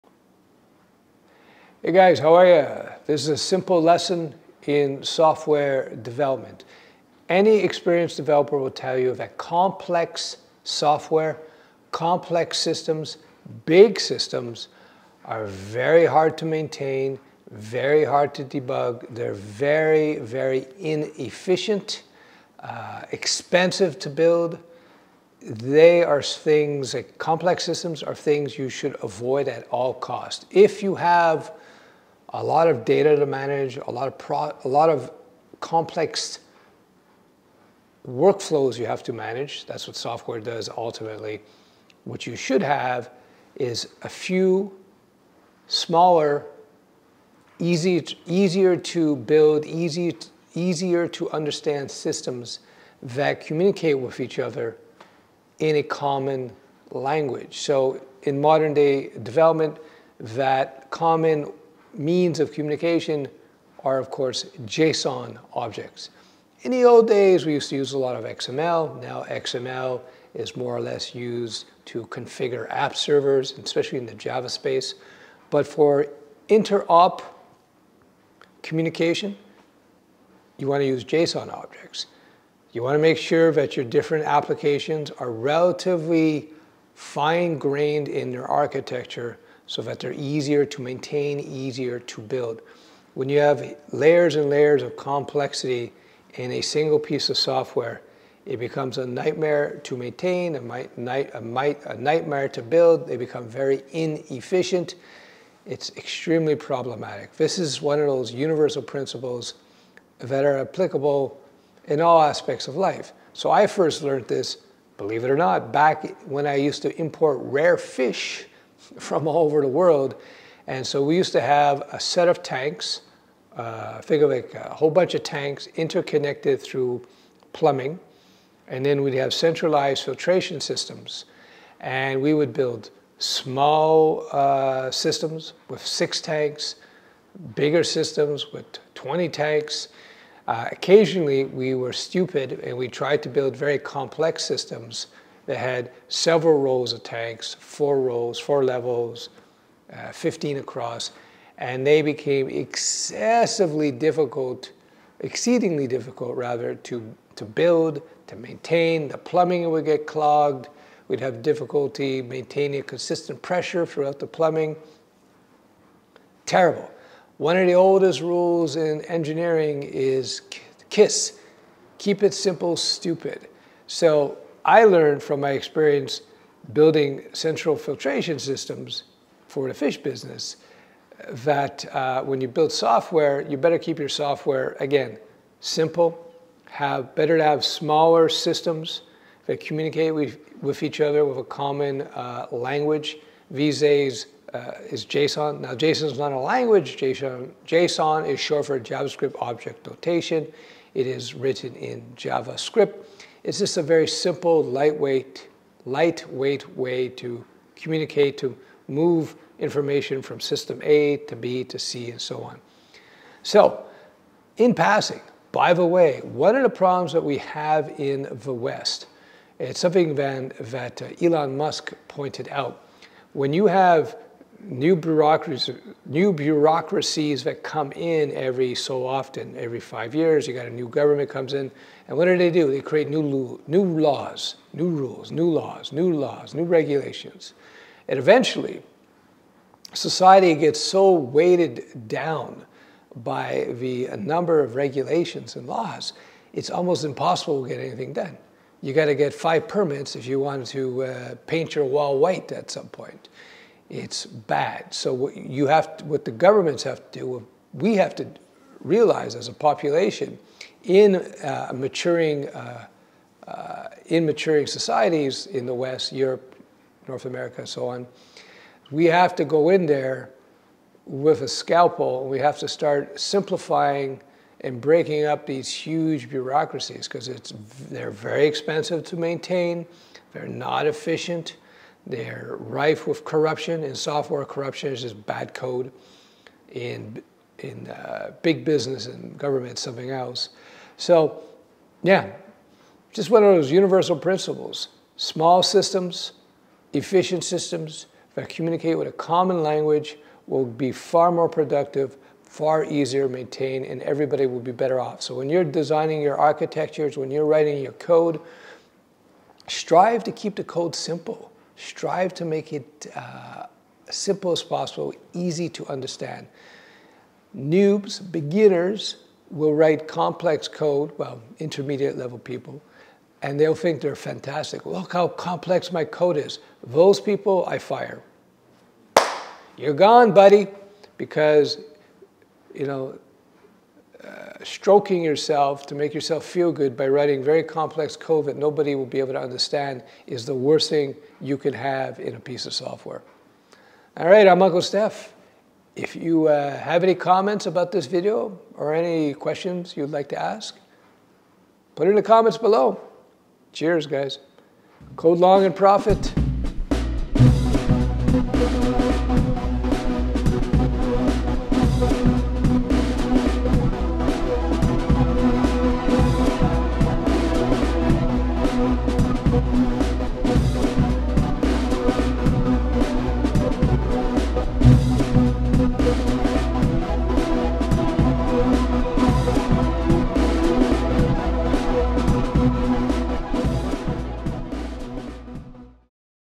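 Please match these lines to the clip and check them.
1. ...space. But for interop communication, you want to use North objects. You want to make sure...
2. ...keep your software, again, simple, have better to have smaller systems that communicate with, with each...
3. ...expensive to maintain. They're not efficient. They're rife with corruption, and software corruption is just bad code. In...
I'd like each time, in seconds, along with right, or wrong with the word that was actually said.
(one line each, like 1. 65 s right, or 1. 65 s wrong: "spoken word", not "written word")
1. 74 s wrong: "JSON", not "North"
2. 183 s right
3. 278 s right.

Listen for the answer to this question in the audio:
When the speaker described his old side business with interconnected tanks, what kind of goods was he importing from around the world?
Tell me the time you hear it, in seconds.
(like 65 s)
117 s.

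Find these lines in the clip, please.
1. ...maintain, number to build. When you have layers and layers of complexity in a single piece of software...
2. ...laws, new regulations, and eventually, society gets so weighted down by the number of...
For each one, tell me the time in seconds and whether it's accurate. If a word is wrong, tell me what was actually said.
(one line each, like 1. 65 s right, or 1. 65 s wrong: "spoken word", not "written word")
1. 90 s wrong: "easier", not "number"
2. 236 s right.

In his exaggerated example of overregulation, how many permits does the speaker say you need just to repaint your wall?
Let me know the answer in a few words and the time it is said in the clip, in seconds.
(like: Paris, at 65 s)
5, at 249 s.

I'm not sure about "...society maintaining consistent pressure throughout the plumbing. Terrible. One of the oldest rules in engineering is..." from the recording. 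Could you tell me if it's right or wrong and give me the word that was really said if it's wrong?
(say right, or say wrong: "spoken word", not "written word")
wrong: "difficulty", not "society".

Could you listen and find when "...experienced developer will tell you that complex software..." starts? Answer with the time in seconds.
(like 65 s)
7 s.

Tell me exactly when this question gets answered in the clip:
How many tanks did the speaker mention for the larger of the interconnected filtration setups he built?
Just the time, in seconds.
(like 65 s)
138 s.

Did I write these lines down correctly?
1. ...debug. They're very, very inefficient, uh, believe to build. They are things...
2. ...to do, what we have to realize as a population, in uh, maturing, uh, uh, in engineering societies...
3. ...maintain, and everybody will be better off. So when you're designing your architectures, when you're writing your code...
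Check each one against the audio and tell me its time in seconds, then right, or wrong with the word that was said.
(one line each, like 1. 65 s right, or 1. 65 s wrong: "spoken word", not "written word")
1. 18 s wrong: "expensive", not "believe"
2. 257 s wrong: "maturing", not "engineering"
3. 303 s right.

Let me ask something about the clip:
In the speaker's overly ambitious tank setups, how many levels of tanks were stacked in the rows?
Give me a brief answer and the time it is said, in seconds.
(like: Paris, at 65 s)
4, at 148 s.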